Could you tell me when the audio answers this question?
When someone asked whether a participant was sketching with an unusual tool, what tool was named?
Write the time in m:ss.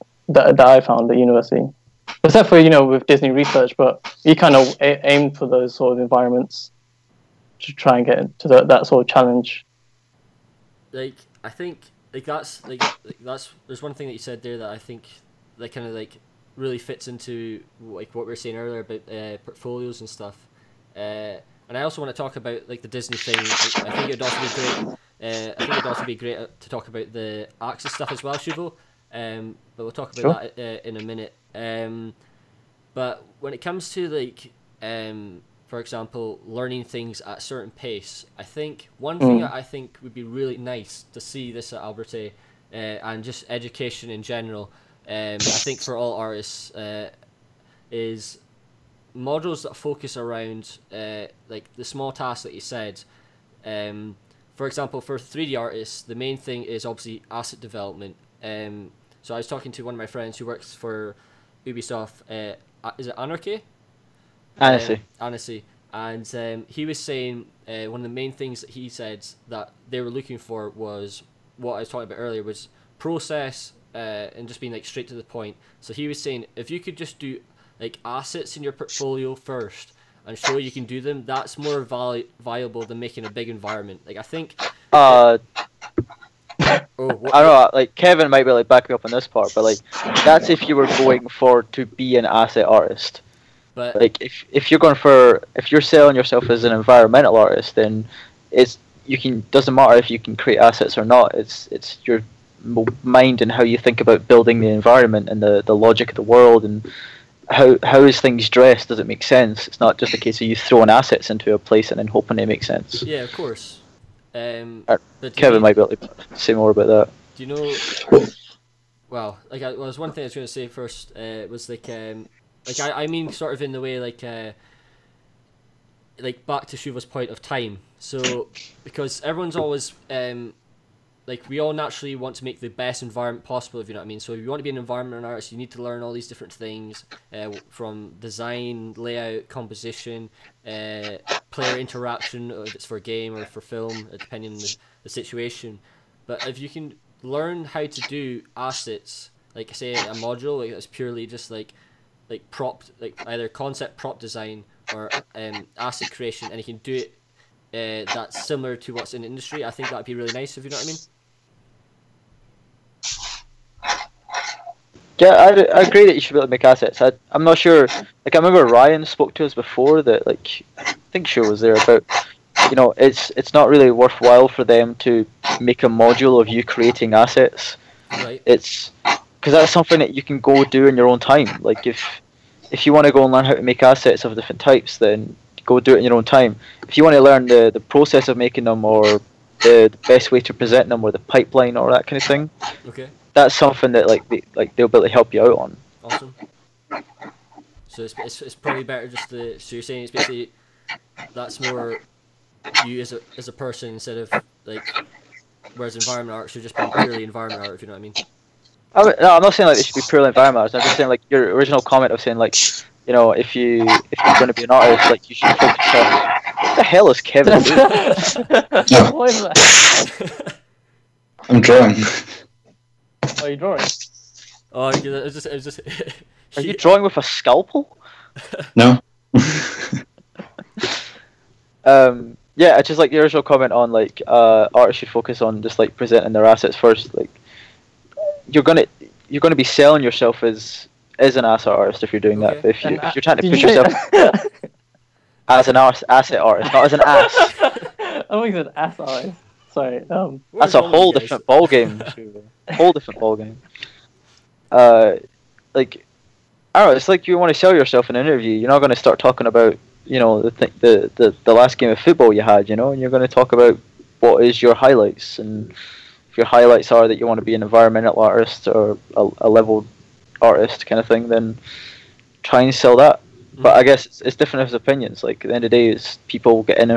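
3:47.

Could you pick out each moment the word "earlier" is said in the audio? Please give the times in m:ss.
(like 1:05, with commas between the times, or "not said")
0:18, 1:12.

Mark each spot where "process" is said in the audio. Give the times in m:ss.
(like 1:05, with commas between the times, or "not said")
1:12, 3:07.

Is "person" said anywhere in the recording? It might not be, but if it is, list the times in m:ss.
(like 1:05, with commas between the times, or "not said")
3:23.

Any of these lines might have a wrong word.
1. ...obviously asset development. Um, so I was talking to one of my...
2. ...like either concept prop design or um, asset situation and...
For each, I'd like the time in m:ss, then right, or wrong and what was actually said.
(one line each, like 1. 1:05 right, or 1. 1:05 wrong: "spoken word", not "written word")
1. 0:56 right
2. 2:32 wrong: "creation", not "situation".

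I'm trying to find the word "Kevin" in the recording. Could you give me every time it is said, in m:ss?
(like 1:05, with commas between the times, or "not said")
1:27, 1:55, 3:37.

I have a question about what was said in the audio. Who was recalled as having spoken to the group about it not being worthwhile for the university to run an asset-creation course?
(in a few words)
Ryan.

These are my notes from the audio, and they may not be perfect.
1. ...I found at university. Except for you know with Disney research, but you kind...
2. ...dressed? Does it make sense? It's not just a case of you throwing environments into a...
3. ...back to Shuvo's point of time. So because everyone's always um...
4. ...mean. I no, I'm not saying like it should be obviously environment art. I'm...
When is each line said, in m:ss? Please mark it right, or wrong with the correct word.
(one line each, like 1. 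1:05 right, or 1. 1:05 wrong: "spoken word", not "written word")
1. 0:00 right
2. 1:48 wrong: "assets", not "environments"
3. 2:06 right
4. 3:28 wrong: "purely", not "obviously".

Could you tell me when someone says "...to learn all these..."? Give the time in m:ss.
2:15.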